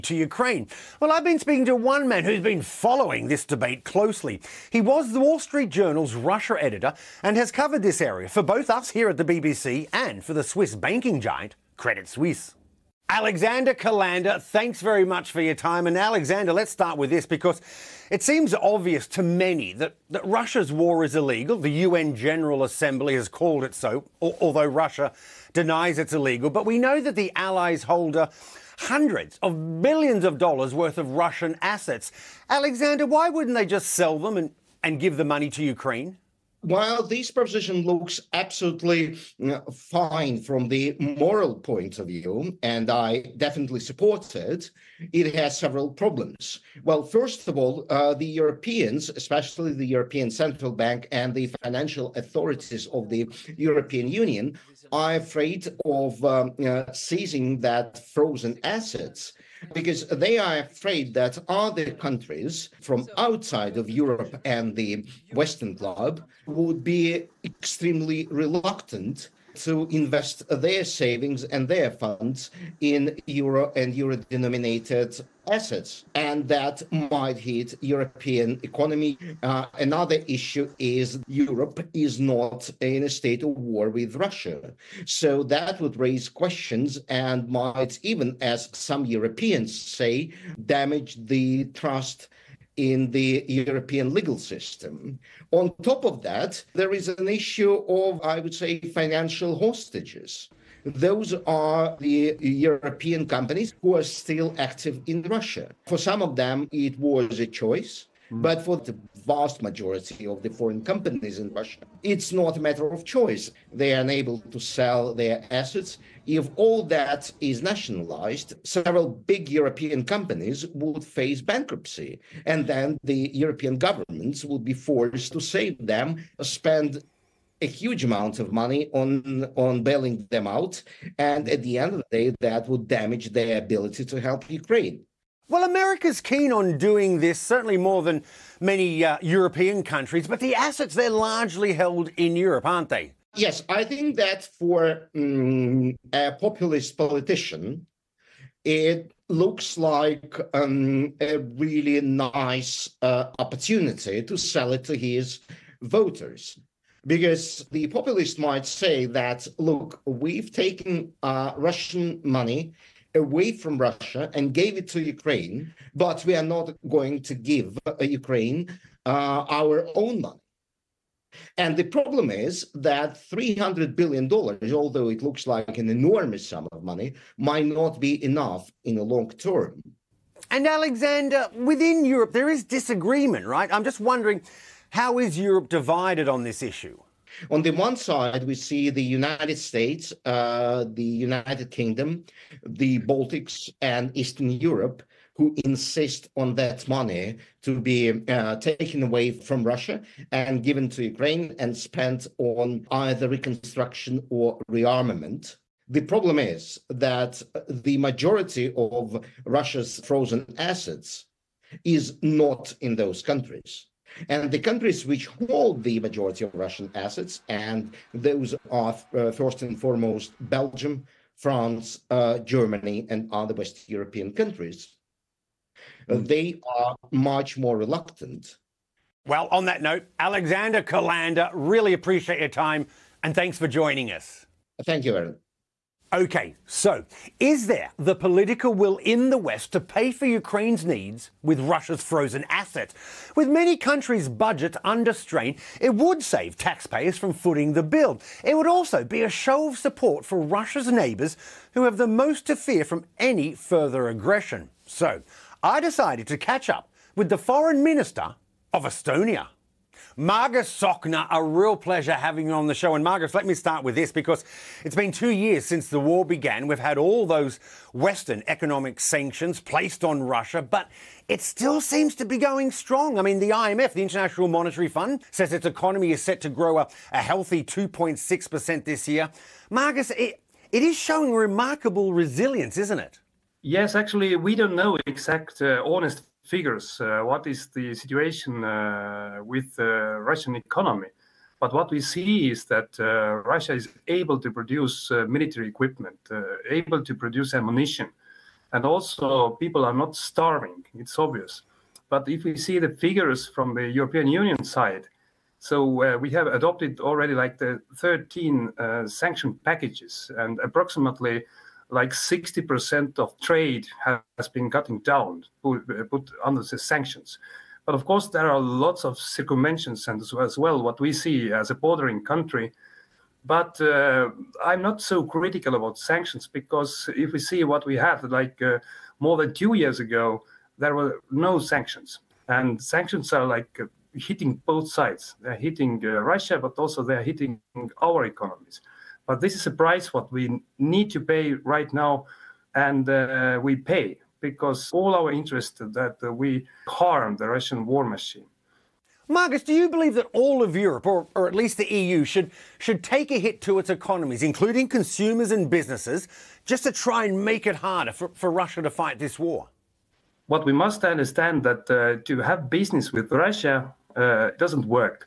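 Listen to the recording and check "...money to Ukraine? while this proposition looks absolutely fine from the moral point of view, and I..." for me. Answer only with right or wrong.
right.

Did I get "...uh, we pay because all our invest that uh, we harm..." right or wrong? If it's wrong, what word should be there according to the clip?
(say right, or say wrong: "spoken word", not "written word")
wrong: "interest", not "invest".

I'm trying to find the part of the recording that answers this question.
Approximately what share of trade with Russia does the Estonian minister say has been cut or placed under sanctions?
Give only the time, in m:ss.
5:12.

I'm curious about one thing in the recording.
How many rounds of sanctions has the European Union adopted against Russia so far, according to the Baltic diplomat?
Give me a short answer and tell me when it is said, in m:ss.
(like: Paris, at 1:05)
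13, at 5:07.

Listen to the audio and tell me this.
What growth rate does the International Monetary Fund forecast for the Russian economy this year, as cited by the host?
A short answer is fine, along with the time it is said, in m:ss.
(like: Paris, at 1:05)
2.6%, at 4:37.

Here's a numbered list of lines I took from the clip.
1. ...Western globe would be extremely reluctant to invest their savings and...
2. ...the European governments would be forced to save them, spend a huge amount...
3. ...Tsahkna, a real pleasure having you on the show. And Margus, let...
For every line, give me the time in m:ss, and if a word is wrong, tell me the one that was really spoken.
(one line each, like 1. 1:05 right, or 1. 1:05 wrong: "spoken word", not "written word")
1. 1:05 right
2. 2:03 right
3. 4:20 right.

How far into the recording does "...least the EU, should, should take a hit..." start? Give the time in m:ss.
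5:51.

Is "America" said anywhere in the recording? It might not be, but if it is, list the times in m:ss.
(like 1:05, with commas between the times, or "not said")
2:15.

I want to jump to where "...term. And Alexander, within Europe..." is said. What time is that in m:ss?
2:59.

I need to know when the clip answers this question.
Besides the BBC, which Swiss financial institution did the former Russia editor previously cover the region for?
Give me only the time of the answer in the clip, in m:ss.
0:11.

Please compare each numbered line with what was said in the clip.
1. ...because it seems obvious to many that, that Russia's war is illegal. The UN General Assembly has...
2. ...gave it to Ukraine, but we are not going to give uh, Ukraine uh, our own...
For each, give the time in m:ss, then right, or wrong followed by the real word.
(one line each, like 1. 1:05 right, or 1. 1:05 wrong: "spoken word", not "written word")
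1. 0:17 right
2. 2:44 right.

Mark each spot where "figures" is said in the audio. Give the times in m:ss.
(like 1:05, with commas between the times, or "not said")
4:46, 5:02.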